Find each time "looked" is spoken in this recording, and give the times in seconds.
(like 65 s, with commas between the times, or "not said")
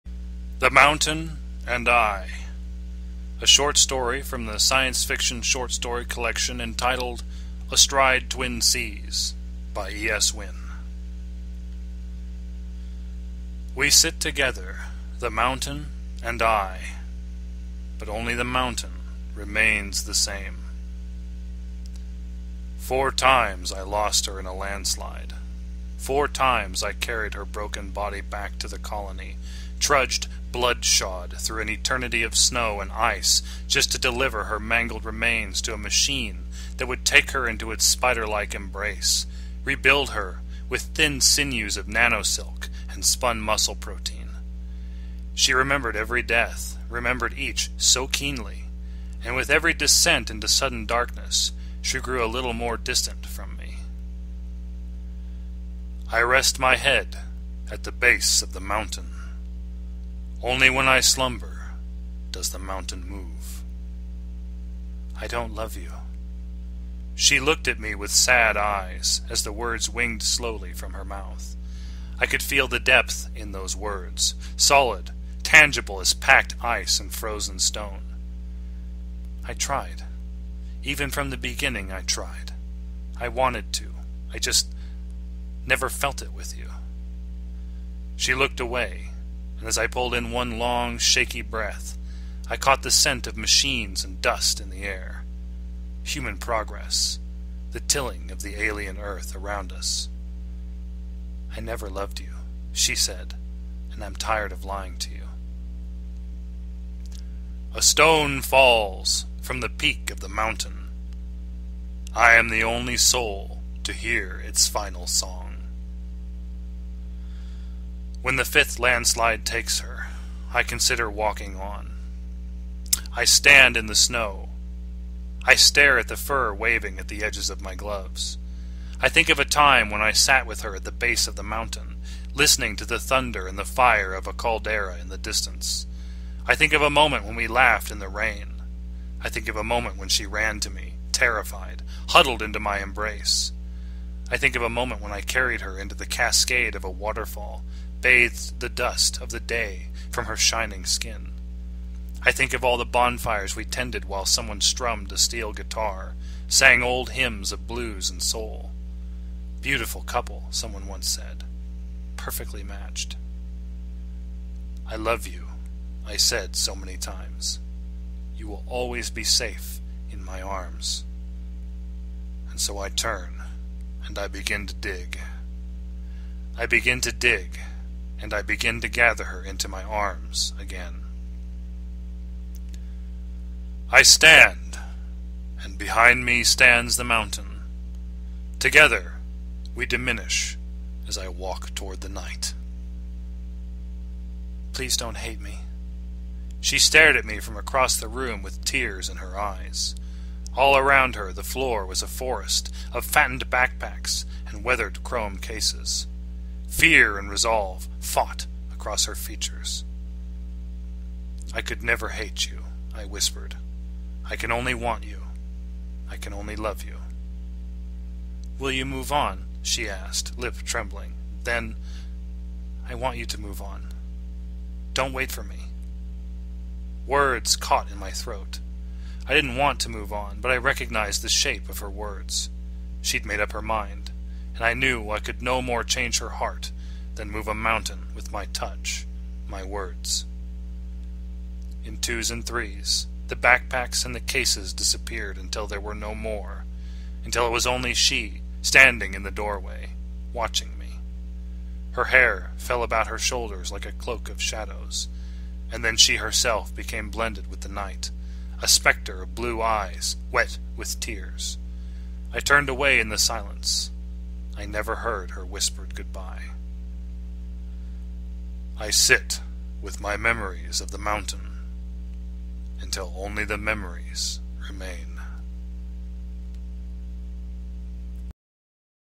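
67 s, 88 s.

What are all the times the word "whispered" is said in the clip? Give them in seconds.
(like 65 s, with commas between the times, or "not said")
213 s, 265 s.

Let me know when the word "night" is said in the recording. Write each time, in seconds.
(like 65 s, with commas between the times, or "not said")
192 s, 257 s.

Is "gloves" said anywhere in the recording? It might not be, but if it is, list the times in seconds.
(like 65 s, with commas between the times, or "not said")
127 s.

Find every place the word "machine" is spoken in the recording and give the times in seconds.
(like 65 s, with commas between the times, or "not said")
35 s, 93 s.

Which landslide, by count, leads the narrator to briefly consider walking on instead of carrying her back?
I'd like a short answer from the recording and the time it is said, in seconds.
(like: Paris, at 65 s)
the fifth, at 118 s.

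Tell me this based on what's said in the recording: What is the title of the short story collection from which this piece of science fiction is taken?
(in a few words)
Astride Twin Seas.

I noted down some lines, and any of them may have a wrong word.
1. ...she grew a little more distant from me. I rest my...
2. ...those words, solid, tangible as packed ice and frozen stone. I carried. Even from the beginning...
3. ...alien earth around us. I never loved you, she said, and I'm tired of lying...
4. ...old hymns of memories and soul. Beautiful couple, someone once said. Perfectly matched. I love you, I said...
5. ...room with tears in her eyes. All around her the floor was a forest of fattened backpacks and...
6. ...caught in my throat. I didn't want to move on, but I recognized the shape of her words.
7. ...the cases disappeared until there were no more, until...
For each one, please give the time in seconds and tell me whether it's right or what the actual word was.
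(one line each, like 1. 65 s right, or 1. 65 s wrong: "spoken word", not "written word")
1. 51 s right
2. 73 s wrong: "tried", not "carried"
3. 98 s right
4. 156 s wrong: "blues", not "memories"
5. 198 s right
6. 227 s right
7. 244 s right.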